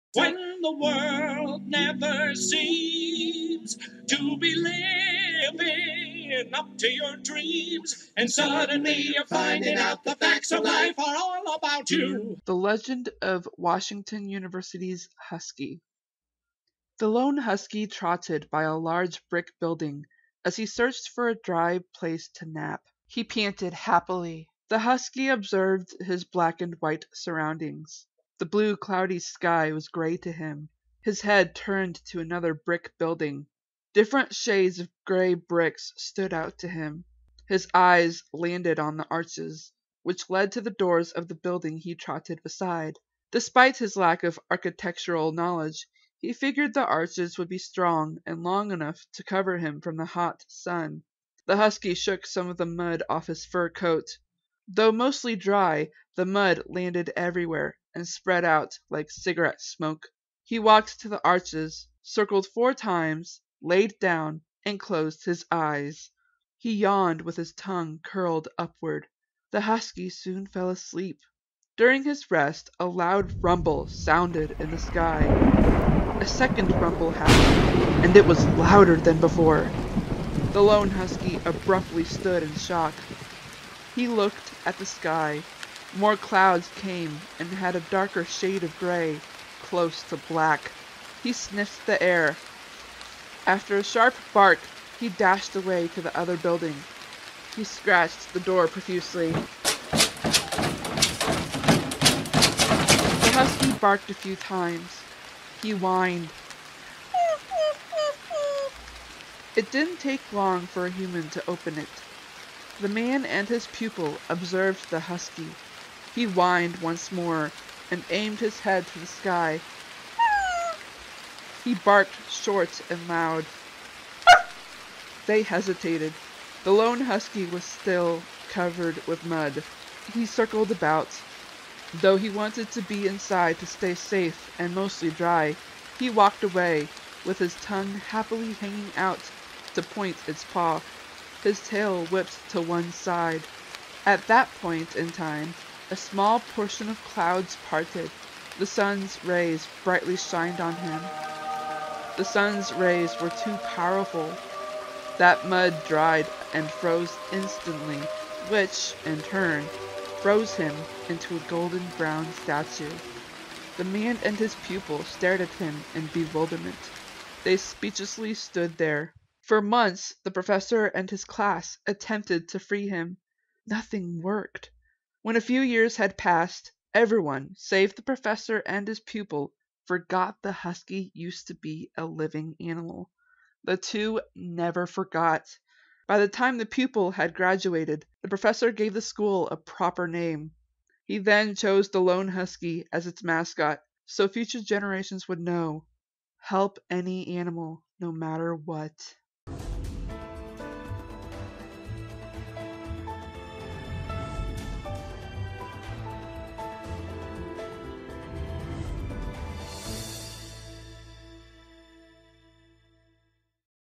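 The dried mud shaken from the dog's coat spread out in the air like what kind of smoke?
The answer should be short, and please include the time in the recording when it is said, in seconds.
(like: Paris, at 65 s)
cigarette smoke, at 59 s.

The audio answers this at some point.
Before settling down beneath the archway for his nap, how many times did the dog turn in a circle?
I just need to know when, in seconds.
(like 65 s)
62 s.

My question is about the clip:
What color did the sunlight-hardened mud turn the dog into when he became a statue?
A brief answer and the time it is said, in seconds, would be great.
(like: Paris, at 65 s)
golden brown, at 161 s.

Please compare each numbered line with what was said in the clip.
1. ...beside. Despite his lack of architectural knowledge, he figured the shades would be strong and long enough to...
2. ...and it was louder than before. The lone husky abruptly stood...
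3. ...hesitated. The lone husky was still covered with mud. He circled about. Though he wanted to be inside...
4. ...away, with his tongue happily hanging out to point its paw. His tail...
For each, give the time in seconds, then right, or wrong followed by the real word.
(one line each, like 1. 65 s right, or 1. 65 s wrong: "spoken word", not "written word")
1. 42 s wrong: "arches", not "shades"
2. 78 s right
3. 125 s right
4. 136 s right.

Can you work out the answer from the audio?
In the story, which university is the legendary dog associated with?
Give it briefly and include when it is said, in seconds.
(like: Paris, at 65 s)
Washington University, at 13 s.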